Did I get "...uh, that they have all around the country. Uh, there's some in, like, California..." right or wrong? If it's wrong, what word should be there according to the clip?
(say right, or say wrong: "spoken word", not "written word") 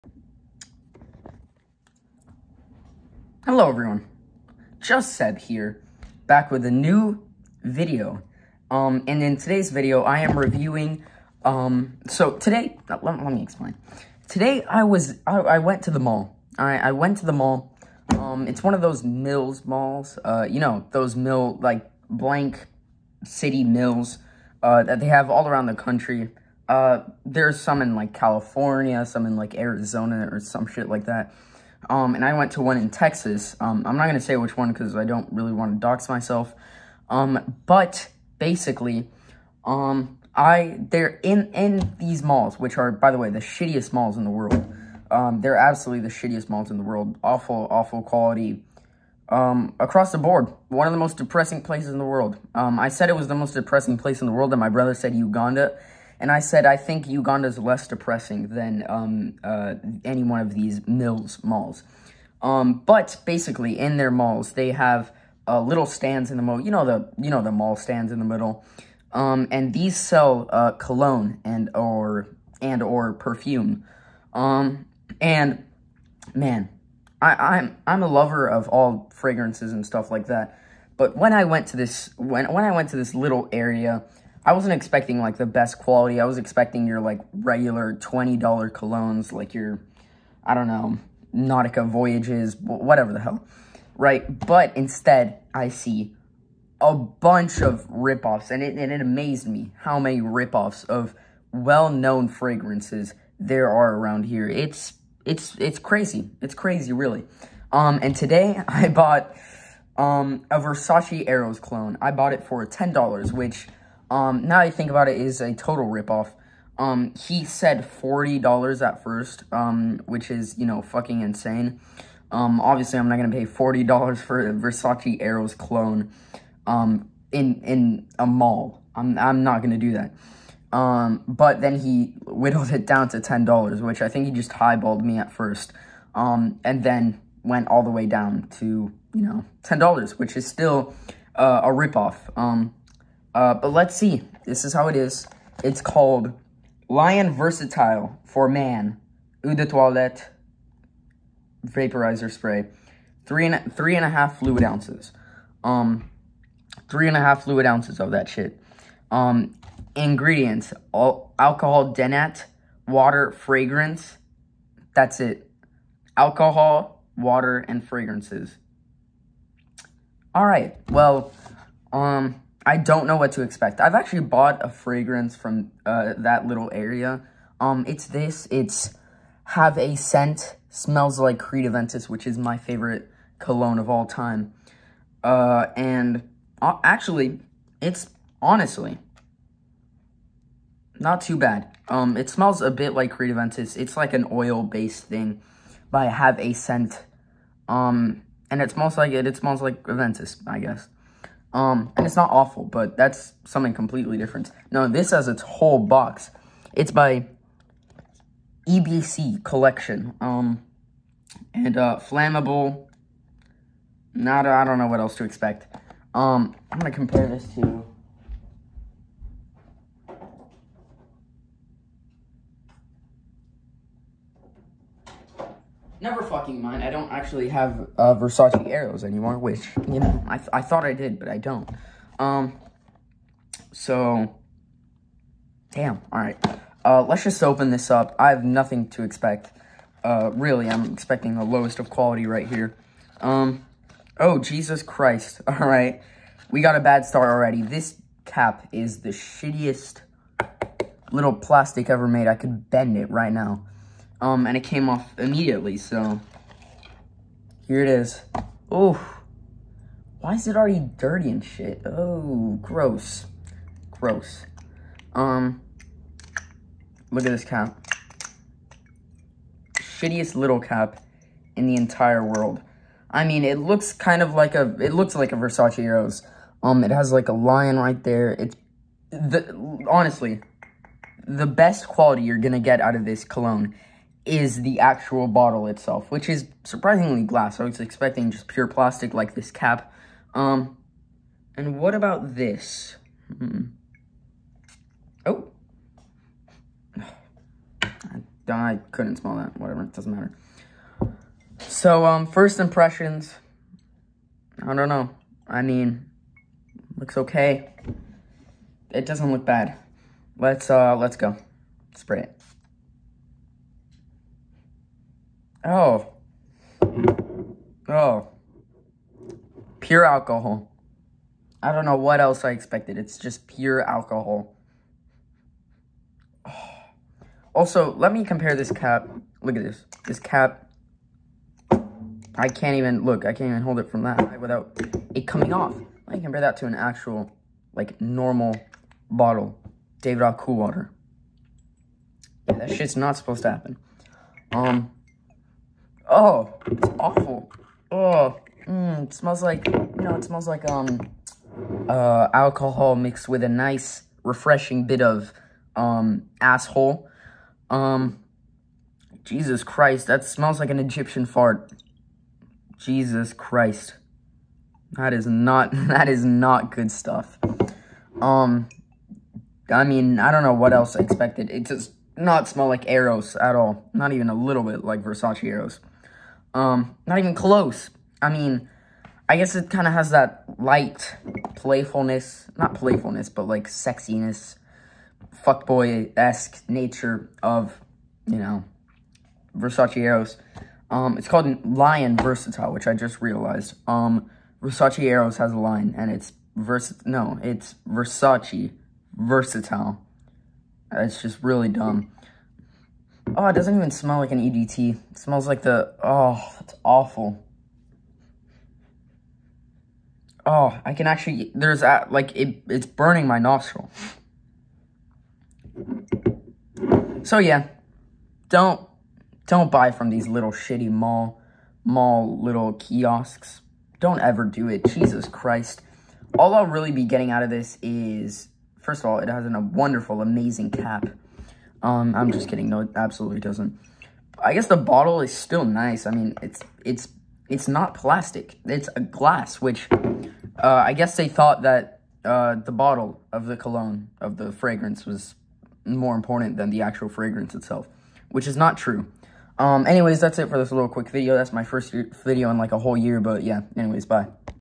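right.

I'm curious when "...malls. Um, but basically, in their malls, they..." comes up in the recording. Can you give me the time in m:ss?
1:01.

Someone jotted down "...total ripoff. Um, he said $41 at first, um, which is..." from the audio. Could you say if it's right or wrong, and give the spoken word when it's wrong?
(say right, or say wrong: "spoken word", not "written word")
wrong: "40", not "41".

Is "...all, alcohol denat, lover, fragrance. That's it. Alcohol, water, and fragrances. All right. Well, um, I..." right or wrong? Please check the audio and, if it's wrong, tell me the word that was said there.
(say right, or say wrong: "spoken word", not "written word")
wrong: "water", not "lover".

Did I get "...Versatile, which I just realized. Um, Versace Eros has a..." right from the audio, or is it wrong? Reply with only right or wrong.
right.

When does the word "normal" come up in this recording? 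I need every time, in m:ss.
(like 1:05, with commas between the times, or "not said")
5:37.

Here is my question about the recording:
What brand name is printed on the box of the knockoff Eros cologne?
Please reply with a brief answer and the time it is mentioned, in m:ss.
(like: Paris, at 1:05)
EBC Collection, at 3:28.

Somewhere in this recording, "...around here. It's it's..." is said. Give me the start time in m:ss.
1:43.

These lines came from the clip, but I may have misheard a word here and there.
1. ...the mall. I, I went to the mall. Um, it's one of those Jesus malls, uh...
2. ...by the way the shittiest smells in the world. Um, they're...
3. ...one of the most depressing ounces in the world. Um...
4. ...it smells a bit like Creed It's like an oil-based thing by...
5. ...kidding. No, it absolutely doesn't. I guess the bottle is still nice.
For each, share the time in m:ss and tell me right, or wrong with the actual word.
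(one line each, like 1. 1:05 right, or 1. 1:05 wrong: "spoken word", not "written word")
1. 0:15 wrong: "Mills", not "Jesus"
2. 0:42 wrong: "malls", not "smells"
3. 0:50 wrong: "places", not "ounces"
4. 3:12 right
5. 7:12 right.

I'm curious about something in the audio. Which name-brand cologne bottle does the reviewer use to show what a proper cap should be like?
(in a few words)
Davidoff Cool Water.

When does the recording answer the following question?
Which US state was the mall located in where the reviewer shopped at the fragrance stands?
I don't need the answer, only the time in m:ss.
0:32.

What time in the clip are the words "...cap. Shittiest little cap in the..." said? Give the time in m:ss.
4:27.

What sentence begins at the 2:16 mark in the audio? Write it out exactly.
Um, and then went all the way down to, you know, $10, which is still, uh, a ripoff.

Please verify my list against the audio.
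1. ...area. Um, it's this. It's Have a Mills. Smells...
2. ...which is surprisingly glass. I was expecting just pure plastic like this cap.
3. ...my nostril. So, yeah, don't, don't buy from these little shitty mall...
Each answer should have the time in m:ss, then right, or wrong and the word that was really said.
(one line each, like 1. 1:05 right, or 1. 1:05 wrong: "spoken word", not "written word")
1. 2:56 wrong: "Scent", not "Mills"
2. 4:46 right
3. 6:53 right.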